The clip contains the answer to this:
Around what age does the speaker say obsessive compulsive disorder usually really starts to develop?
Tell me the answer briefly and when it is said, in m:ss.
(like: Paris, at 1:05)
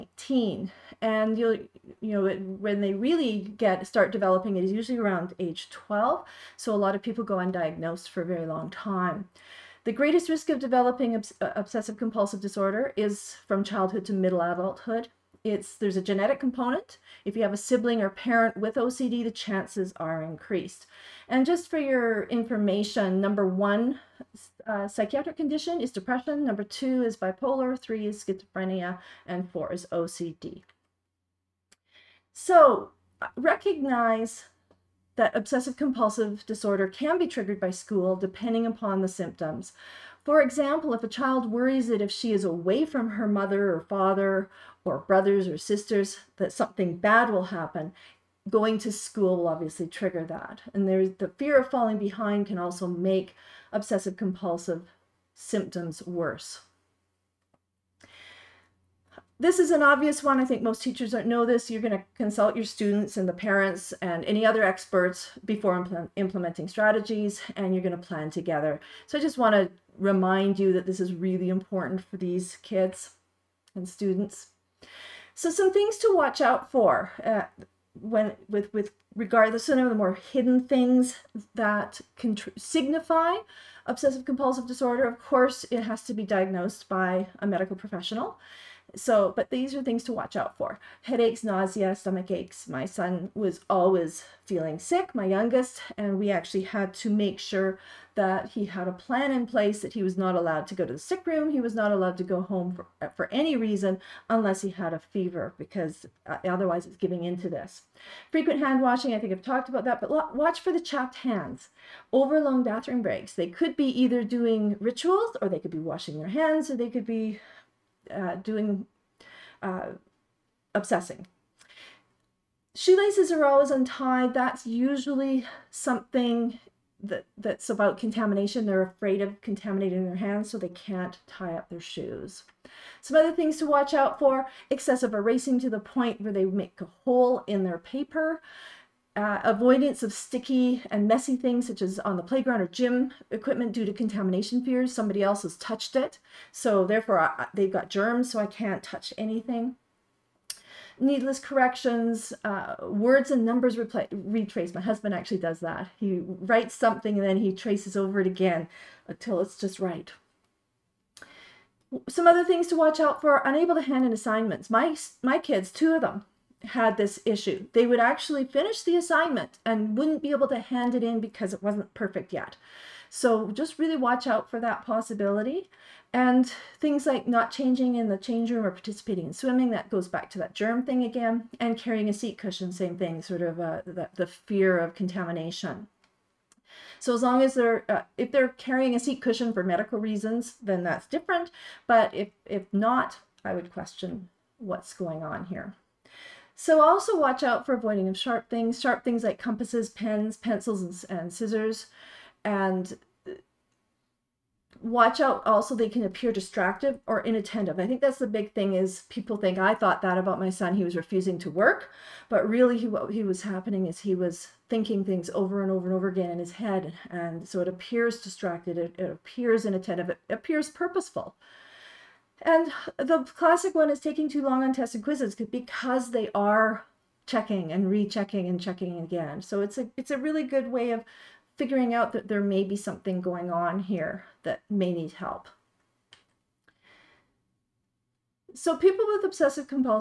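12, at 0:05.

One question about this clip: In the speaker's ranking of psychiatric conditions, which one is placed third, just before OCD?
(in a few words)
Schizophrenia.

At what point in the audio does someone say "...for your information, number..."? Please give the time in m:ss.
0:21.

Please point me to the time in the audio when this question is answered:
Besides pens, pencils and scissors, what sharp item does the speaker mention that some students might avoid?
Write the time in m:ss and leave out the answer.
3:19.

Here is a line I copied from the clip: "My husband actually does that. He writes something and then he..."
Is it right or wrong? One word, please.
right.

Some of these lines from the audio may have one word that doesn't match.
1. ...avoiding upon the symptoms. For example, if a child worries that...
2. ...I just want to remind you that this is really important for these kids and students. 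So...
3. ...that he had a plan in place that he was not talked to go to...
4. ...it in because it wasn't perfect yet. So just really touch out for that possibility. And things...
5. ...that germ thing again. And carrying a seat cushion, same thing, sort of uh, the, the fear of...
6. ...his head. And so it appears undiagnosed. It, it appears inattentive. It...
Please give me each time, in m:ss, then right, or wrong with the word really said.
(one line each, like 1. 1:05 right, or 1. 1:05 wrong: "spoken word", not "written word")
1. 0:38 wrong: "depending", not "avoiding"
2. 1:09 right
3. 1:38 wrong: "allowed", not "talked"
4. 2:50 wrong: "watch", not "touch"
5. 3:00 right
6. 3:36 wrong: "distracted", not "undiagnosed".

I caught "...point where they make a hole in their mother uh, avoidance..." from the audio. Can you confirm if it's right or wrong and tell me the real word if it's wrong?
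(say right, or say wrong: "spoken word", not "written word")
wrong: "paper", not "mother".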